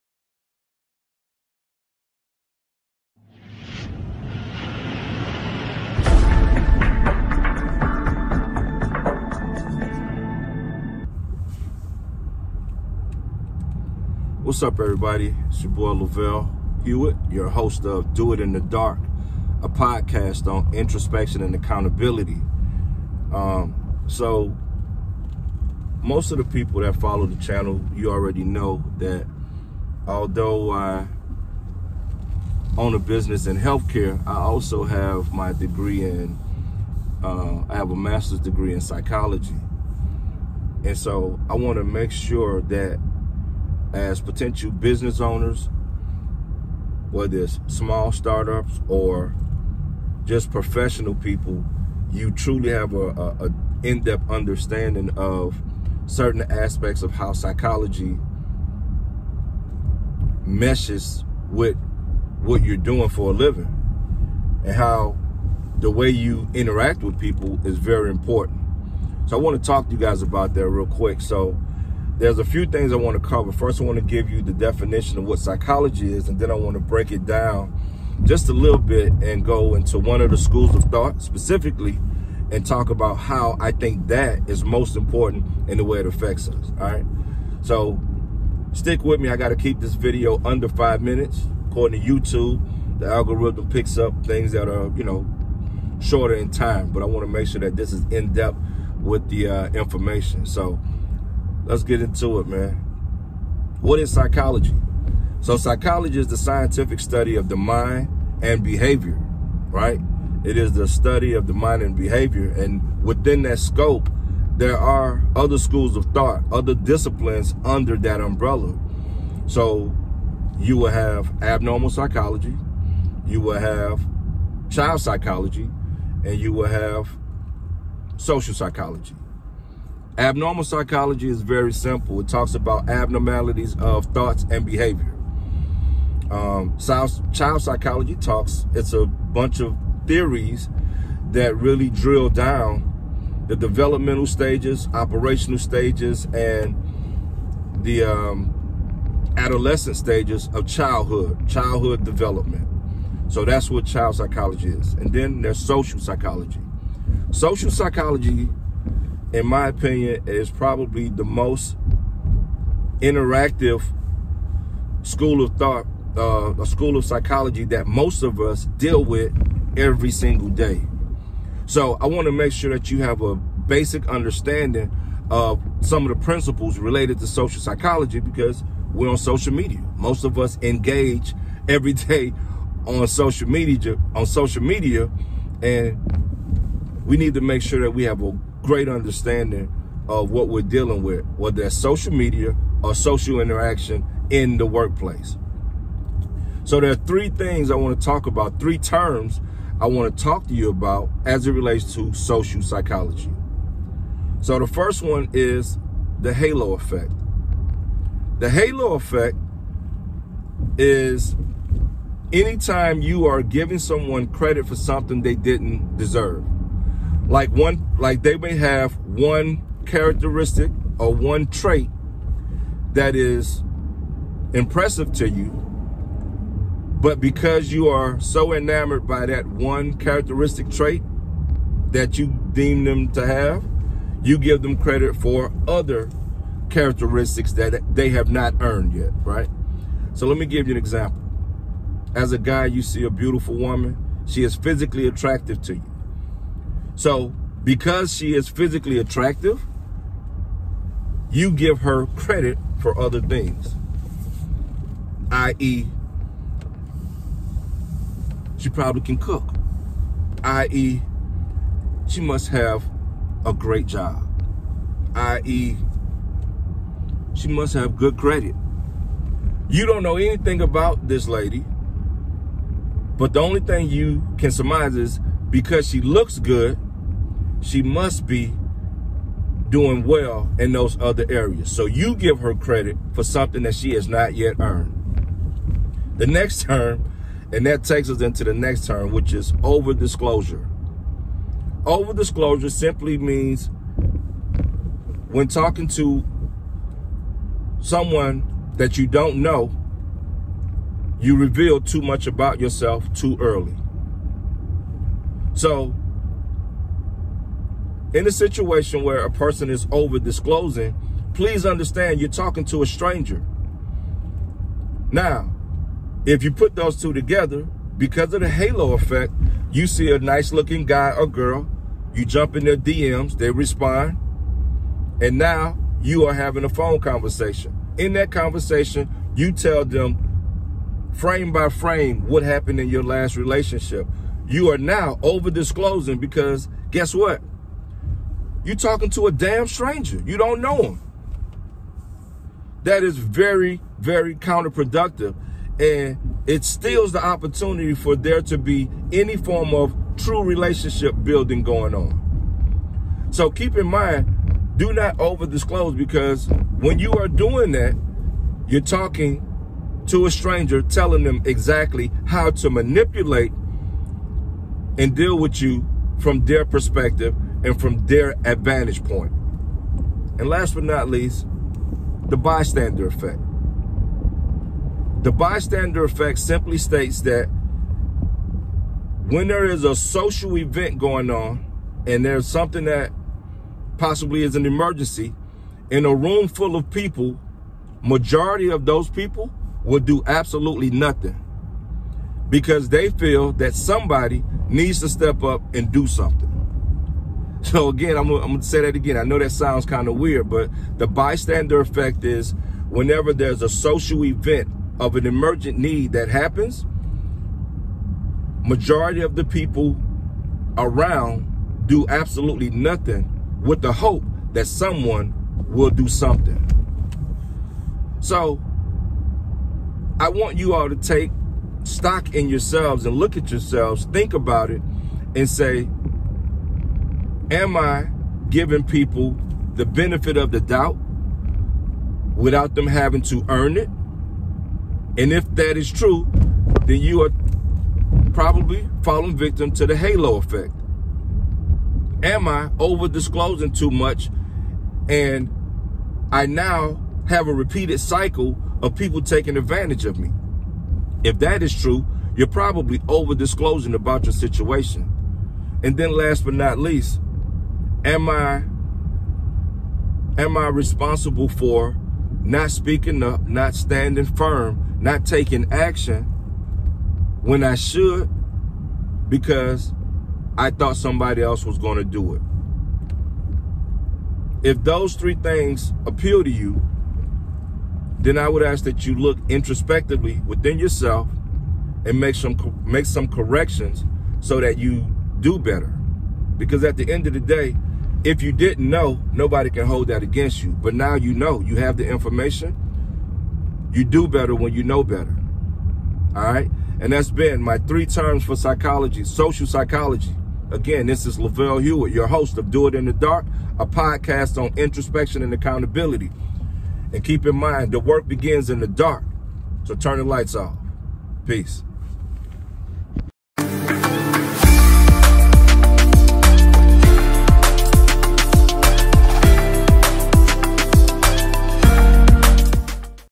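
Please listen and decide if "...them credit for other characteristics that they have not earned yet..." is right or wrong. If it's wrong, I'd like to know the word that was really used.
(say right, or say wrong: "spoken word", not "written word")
right.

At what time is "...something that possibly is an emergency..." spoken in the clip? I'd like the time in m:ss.
6:22.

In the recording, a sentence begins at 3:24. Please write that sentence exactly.
So the first one is the halo effect.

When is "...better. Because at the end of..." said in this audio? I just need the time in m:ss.
8:05.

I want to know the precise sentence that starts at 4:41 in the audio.
So you give her credit for something that she has not yet earned.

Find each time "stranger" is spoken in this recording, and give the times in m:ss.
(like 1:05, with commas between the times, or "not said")
5:12, 5:39, 6:00.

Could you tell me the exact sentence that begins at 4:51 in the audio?
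Over disclosure simply means when talking to someone that you don't know, you reveal too much about yourself too early.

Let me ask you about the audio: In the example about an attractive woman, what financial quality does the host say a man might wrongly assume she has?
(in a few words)
Good credit.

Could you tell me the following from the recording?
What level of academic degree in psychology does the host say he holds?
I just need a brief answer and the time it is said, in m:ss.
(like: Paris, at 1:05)
Master's degree, at 0:37.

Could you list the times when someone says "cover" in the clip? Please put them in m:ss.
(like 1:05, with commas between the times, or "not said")
1:13.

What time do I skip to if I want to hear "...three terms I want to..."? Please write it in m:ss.
3:18.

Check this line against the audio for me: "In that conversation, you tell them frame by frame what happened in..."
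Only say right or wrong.
right.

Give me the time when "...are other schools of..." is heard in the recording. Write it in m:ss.
1:54.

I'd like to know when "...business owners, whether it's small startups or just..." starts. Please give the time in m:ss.
0:44.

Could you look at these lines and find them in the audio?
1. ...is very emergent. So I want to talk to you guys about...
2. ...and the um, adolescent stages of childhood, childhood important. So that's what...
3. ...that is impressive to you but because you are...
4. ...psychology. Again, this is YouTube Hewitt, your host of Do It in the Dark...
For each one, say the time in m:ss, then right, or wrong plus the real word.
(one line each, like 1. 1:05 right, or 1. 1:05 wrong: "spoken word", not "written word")
1. 1:07 wrong: "important", not "emergent"
2. 2:26 wrong: "development", not "important"
3. 3:42 right
4. 8:19 wrong: "Lavelle", not "YouTube".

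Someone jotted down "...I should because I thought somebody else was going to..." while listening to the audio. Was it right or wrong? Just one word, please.
right.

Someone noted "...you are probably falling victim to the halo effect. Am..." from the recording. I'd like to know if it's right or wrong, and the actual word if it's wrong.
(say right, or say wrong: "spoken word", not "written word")
right.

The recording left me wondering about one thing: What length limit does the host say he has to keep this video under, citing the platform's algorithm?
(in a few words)
5 minutes.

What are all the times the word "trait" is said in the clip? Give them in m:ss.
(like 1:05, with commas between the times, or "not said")
3:41, 3:50.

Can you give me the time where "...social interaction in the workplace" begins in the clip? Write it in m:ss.
3:12.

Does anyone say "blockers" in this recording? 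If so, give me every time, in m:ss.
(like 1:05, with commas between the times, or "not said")
not said.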